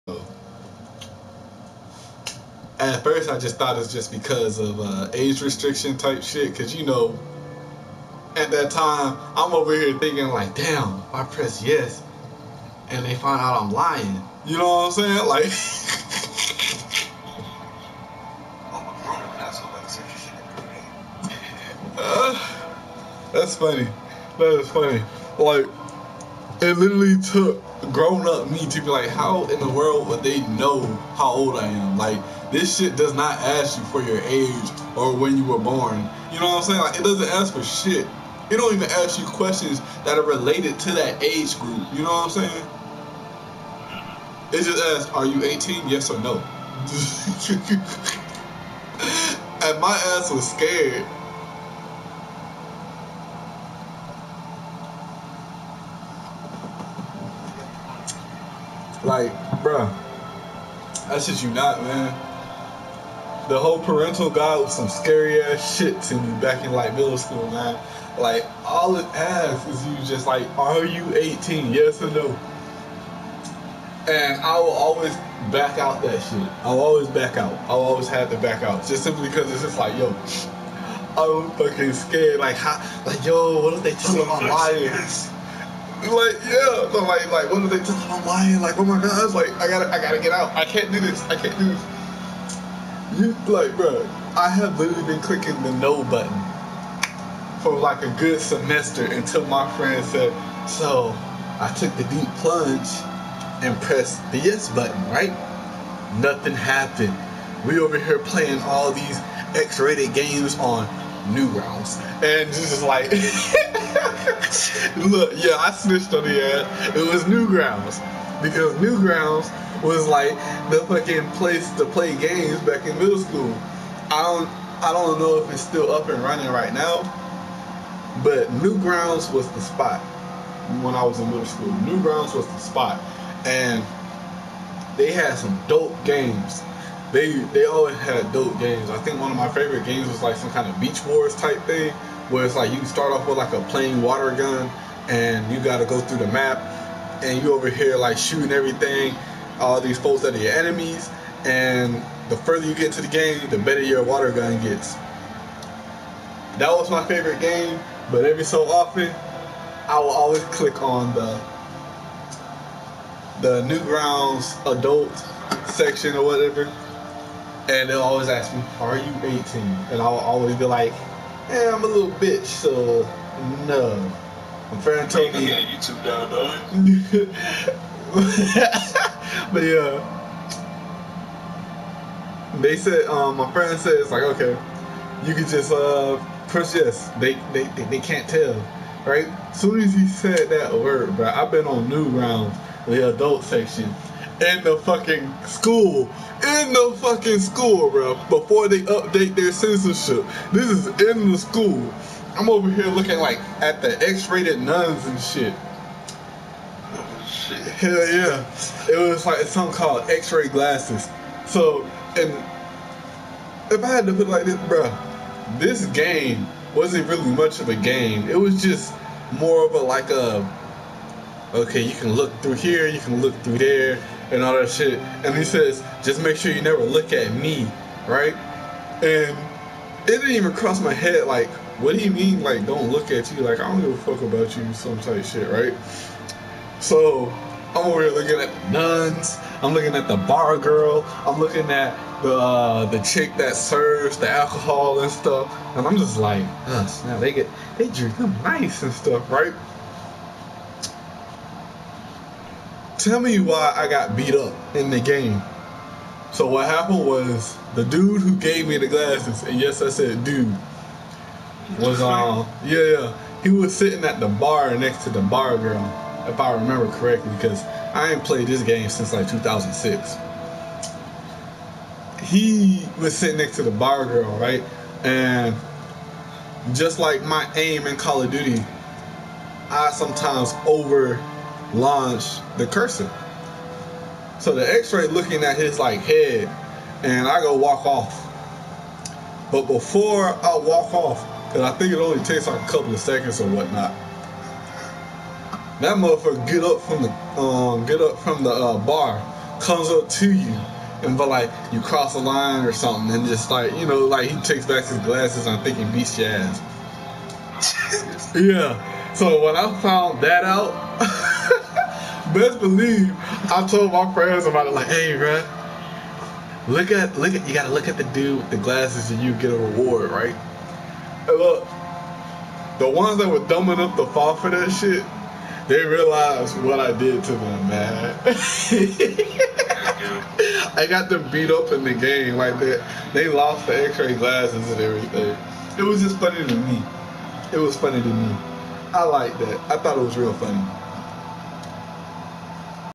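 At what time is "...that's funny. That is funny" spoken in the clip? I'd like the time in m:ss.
0:23.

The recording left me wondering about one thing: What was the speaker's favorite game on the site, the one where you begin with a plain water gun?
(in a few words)
Beach Wars.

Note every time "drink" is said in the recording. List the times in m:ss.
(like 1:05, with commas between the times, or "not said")
4:07.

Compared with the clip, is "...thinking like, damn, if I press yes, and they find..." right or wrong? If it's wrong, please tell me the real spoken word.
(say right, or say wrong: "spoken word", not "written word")
right.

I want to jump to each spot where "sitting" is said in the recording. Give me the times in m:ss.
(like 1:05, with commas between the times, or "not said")
4:23, 4:33.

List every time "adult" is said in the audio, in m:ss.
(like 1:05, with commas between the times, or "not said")
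2:44, 3:13.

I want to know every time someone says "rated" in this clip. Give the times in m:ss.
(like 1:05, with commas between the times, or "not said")
1:49, 3:24.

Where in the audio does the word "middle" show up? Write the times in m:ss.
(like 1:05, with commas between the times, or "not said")
1:06, 2:02, 2:11.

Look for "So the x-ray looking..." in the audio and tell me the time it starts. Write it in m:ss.
4:44.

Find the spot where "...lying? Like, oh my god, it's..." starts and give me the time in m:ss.
1:28.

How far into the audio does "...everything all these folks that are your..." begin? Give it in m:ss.
2:28.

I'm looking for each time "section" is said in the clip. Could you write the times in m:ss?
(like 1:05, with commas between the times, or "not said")
2:45, 3:13.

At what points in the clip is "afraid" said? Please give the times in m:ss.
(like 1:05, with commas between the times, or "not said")
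not said.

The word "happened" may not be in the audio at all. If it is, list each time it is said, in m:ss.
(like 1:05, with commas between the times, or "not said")
1:46, 4:16.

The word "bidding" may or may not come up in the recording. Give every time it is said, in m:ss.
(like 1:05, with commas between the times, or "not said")
not said.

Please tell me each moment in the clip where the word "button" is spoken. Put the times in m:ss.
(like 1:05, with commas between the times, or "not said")
1:36, 1:44.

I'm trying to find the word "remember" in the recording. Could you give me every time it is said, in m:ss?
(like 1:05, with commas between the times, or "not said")
4:26.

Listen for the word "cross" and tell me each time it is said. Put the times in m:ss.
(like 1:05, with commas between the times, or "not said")
3:50, 5:01.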